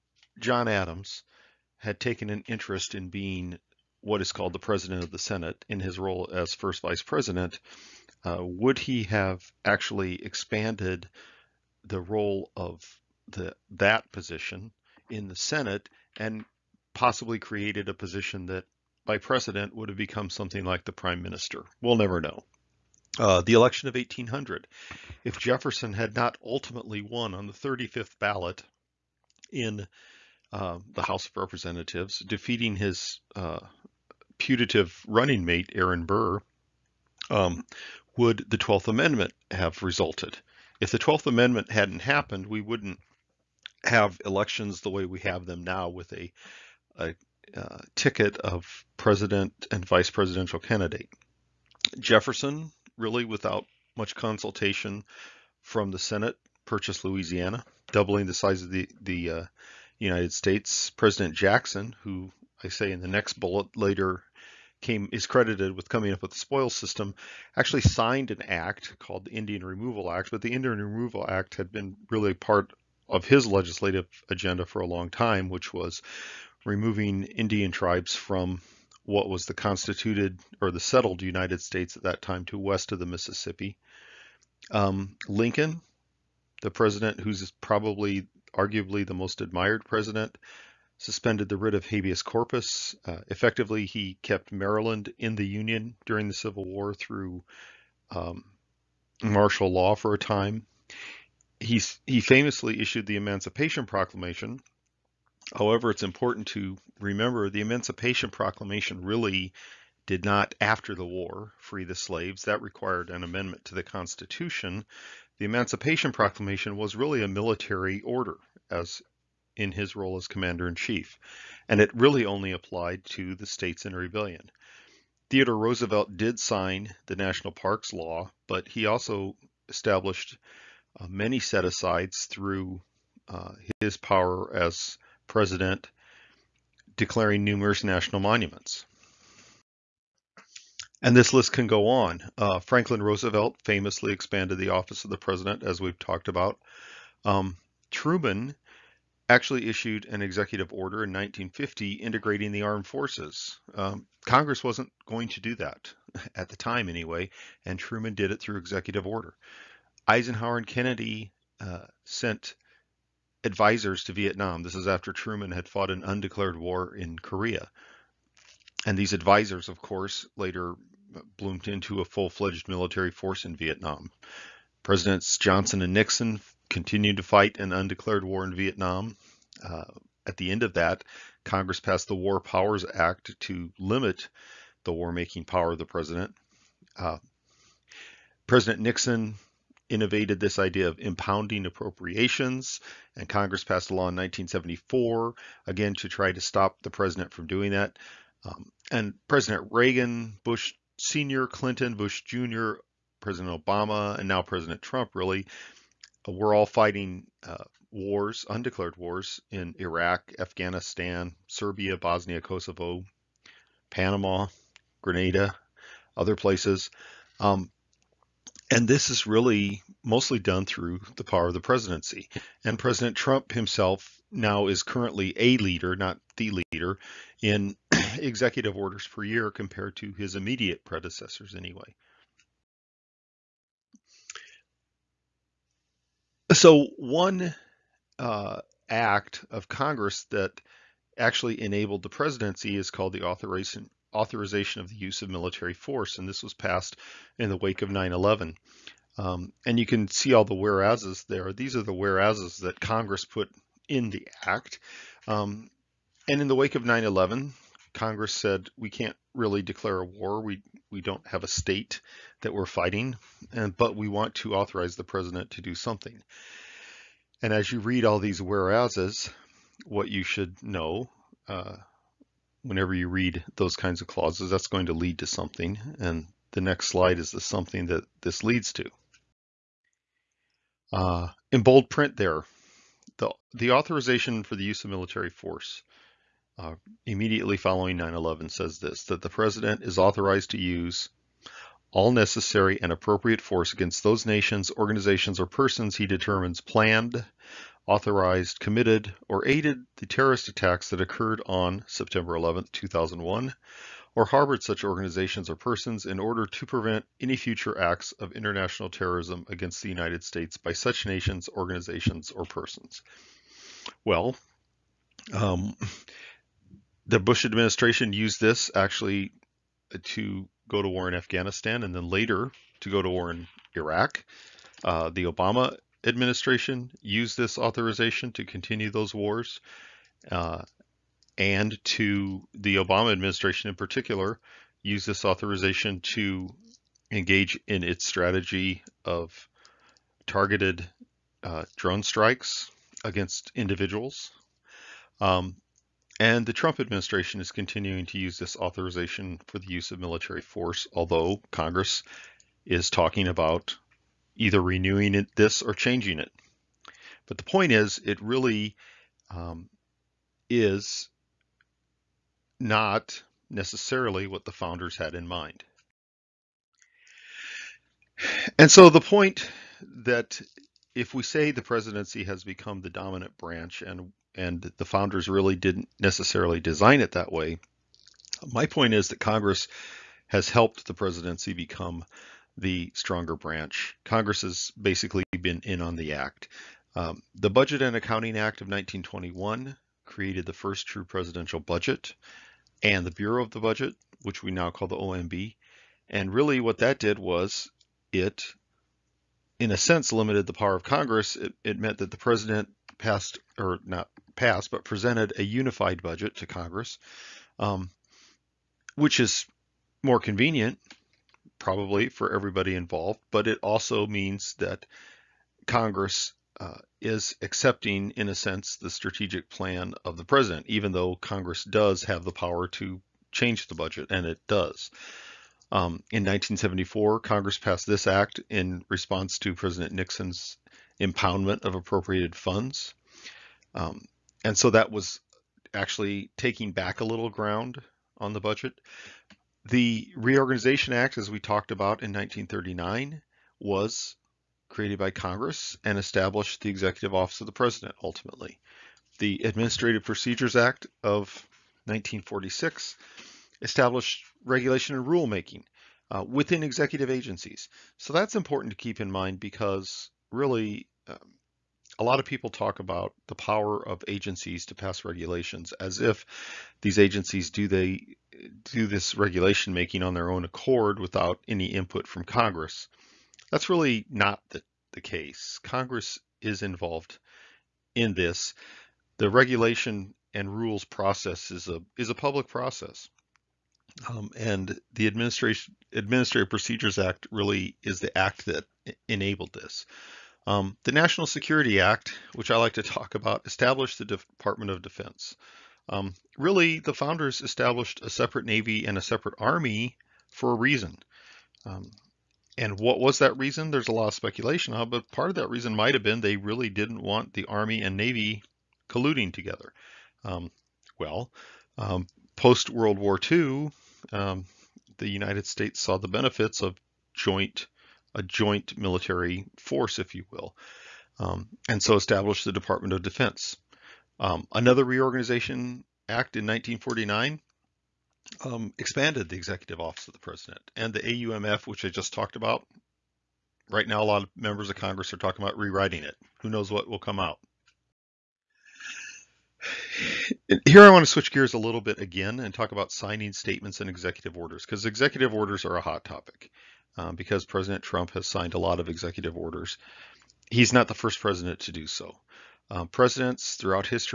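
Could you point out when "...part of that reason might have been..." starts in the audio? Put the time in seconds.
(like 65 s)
505 s.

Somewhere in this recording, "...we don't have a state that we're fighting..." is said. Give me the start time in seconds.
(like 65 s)
260 s.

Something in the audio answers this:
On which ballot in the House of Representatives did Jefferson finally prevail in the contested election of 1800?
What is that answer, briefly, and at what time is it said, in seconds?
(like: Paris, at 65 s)
35th, at 27 s.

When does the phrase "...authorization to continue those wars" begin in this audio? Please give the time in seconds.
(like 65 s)
327 s.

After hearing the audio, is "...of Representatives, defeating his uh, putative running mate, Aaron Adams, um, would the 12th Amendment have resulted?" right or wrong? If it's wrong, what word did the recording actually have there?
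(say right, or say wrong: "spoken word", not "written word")
wrong: "Burr", not "Adams".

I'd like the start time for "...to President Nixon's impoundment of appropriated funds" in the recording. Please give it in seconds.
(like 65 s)
429 s.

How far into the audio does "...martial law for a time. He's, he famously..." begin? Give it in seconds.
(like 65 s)
99 s.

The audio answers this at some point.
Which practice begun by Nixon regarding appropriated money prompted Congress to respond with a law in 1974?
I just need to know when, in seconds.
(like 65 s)
190 s.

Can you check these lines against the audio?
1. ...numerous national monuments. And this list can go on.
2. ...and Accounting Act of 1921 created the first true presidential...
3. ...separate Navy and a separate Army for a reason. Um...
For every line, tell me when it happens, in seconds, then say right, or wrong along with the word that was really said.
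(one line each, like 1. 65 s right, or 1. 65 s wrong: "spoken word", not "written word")
1. 137 s right
2. 387 s right
3. 498 s right.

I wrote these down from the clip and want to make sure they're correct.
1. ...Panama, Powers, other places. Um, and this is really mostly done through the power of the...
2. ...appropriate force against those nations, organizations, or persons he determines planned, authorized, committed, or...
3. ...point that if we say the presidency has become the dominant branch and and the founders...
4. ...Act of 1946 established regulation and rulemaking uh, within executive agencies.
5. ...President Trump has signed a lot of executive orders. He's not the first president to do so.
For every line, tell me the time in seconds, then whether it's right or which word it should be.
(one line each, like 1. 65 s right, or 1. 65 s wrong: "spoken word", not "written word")
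1. 213 s wrong: "Grenada", not "Powers"
2. 292 s right
3. 369 s right
4. 450 s right
5. 547 s right.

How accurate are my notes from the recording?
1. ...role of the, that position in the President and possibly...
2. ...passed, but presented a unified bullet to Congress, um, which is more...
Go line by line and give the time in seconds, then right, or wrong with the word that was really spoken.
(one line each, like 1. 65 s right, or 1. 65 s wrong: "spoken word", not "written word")
1. 12 s wrong: "Senate", not "President"
2. 404 s wrong: "budget", not "bullet".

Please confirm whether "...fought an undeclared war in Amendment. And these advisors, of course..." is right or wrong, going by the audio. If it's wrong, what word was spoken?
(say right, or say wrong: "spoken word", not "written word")
wrong: "Korea", not "Amendment".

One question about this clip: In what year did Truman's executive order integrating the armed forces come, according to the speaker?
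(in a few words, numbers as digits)
1950.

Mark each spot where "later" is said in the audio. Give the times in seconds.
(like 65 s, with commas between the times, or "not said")
63 s, 170 s, 322 s.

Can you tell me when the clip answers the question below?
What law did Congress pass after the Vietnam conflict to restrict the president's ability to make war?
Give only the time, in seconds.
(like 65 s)
182 s.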